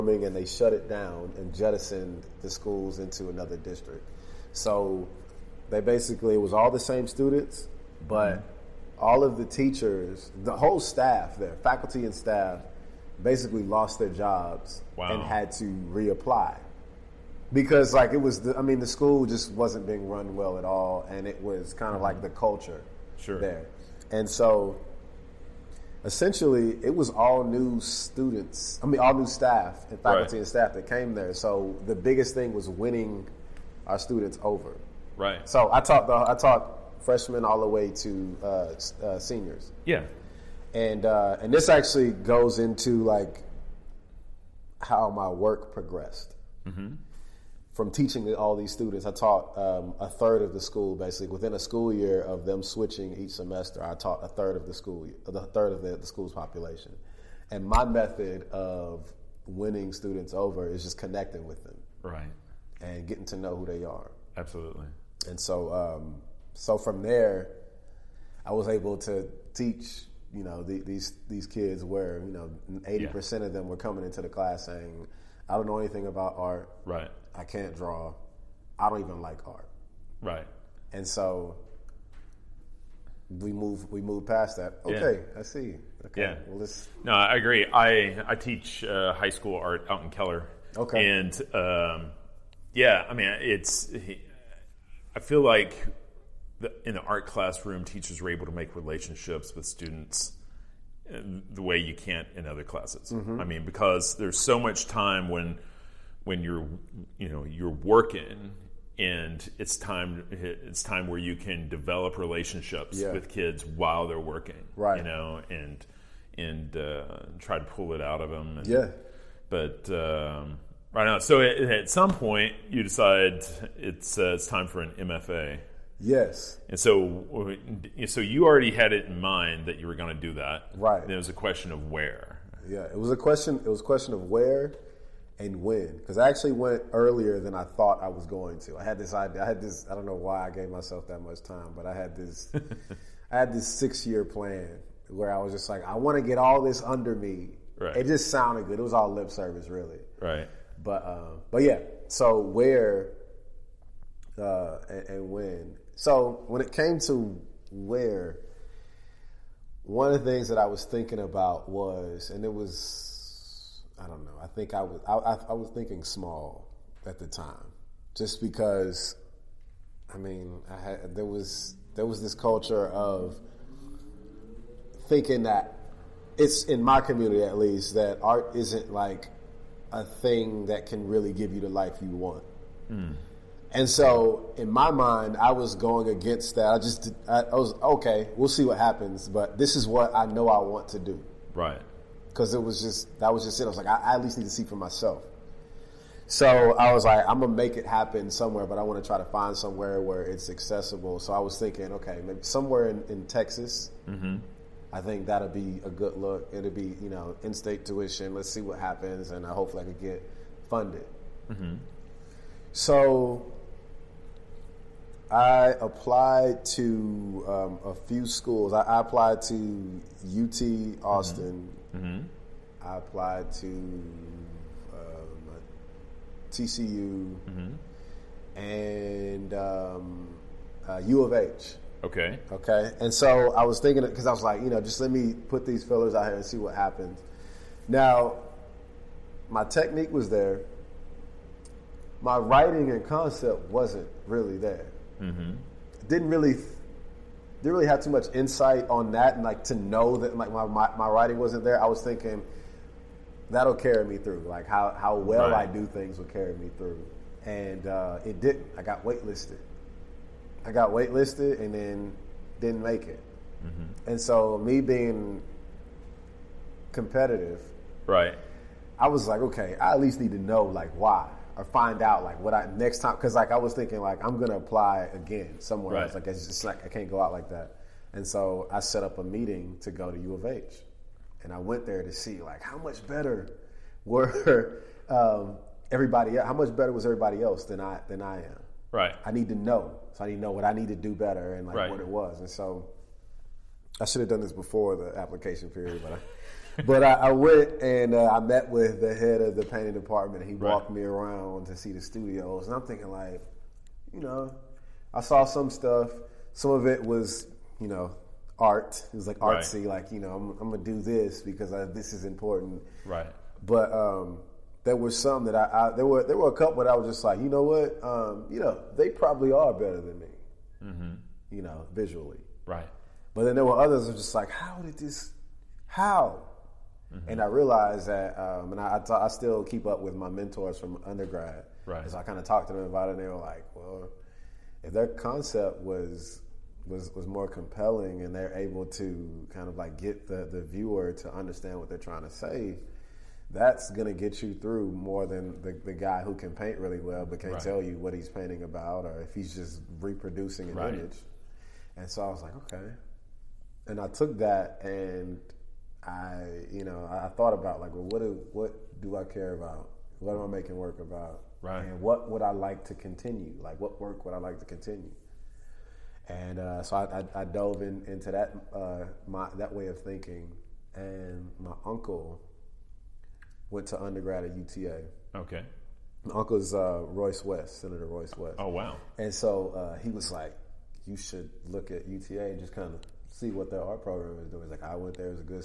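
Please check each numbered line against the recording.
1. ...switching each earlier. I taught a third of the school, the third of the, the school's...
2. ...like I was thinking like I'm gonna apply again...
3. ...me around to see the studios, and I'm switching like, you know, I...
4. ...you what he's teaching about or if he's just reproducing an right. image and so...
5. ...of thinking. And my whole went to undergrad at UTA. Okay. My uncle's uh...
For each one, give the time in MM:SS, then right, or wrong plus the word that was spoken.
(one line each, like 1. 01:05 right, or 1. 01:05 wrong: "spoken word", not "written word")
1. 00:52 wrong: "semester", not "earlier"
2. 04:33 right
3. 05:00 wrong: "thinking", not "switching"
4. 05:47 wrong: "painting", not "teaching"
5. 06:09 wrong: "uncle", not "whole".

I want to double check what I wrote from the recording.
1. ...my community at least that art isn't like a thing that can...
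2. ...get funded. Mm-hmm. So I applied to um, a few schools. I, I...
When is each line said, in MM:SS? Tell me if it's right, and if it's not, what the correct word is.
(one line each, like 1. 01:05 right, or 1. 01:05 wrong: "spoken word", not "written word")
1. 02:56 right
2. 03:30 right.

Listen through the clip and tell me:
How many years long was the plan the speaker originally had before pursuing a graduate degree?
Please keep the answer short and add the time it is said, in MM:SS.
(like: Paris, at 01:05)
6 years, at 02:23.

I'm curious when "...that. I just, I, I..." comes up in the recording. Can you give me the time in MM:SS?
03:06.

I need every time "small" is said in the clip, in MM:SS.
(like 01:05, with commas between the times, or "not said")
02:46.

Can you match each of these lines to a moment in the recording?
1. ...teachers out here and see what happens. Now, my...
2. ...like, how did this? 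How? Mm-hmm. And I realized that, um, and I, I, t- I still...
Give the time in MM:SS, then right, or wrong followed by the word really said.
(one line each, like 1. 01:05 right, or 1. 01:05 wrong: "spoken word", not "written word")
1. 03:55 wrong: "fillers", not "teachers"
2. 05:24 right.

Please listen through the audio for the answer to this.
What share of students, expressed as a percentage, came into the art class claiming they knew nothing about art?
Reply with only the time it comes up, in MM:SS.
01:12.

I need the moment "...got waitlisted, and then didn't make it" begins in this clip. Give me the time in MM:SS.
04:20.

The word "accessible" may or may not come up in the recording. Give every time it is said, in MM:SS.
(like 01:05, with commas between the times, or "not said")
03:20.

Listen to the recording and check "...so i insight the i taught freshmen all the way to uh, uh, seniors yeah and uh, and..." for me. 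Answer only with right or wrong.
wrong.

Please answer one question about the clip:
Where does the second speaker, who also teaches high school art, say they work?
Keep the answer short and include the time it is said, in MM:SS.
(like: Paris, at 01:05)
Keller, at 01:30.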